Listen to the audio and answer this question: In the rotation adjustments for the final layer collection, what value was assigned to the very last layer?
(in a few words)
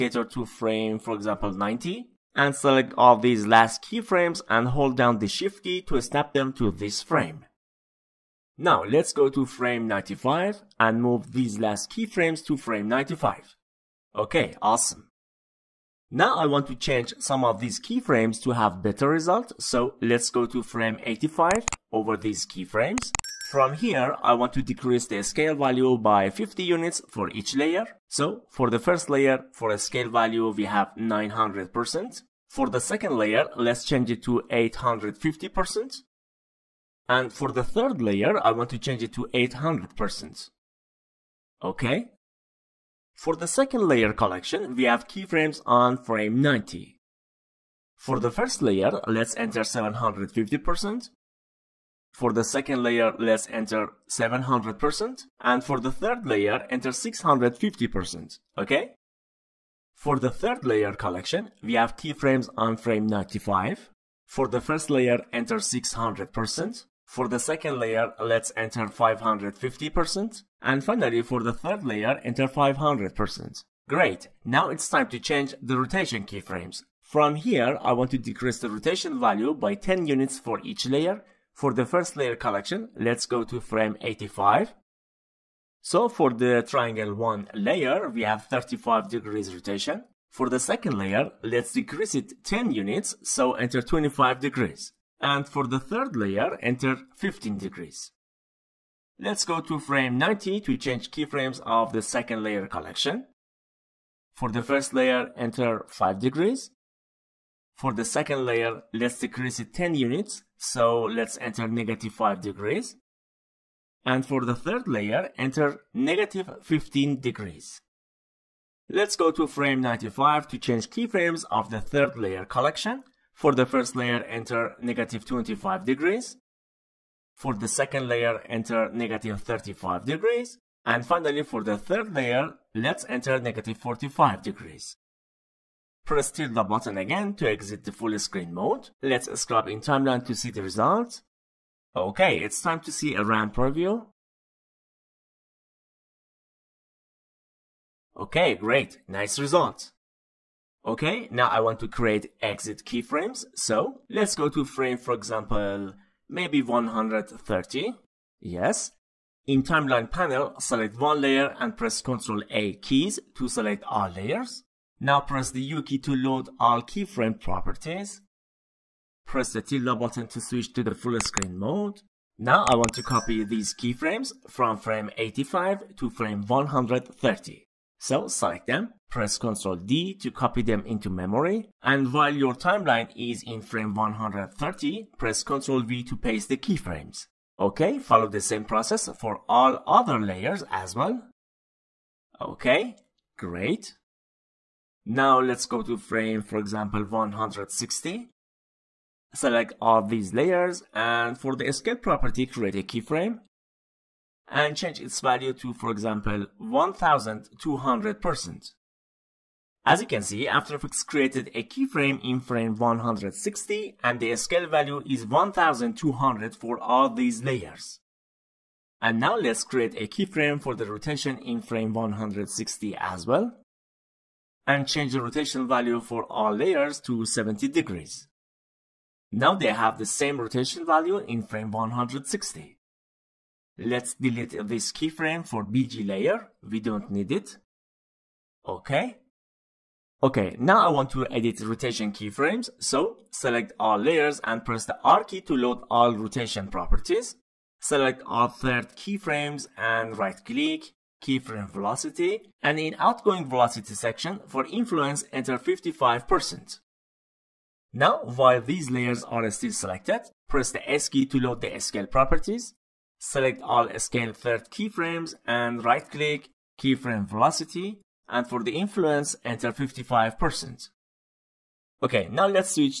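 -45 degrees.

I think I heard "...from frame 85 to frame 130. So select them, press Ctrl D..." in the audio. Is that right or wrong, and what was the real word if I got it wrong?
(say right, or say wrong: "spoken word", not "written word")
right.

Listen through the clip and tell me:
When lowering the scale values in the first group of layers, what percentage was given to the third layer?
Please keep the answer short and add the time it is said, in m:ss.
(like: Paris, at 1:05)
800%, at 0:39.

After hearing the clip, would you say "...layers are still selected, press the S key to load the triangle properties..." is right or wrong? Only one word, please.
wrong.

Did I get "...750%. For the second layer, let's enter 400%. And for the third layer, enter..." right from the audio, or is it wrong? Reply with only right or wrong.
wrong.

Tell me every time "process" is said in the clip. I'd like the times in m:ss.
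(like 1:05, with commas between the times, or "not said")
3:08.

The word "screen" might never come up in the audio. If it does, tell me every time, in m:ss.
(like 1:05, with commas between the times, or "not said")
2:18, 2:51.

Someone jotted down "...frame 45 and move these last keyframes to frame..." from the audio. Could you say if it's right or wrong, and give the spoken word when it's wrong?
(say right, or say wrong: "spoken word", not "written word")
wrong: "95", not "45".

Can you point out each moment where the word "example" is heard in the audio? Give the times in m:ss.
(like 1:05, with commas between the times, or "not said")
0:01, 2:35, 3:16, 3:25.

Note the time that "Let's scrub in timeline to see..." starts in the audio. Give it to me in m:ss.
2:19.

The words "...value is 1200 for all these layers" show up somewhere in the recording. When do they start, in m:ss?
3:34.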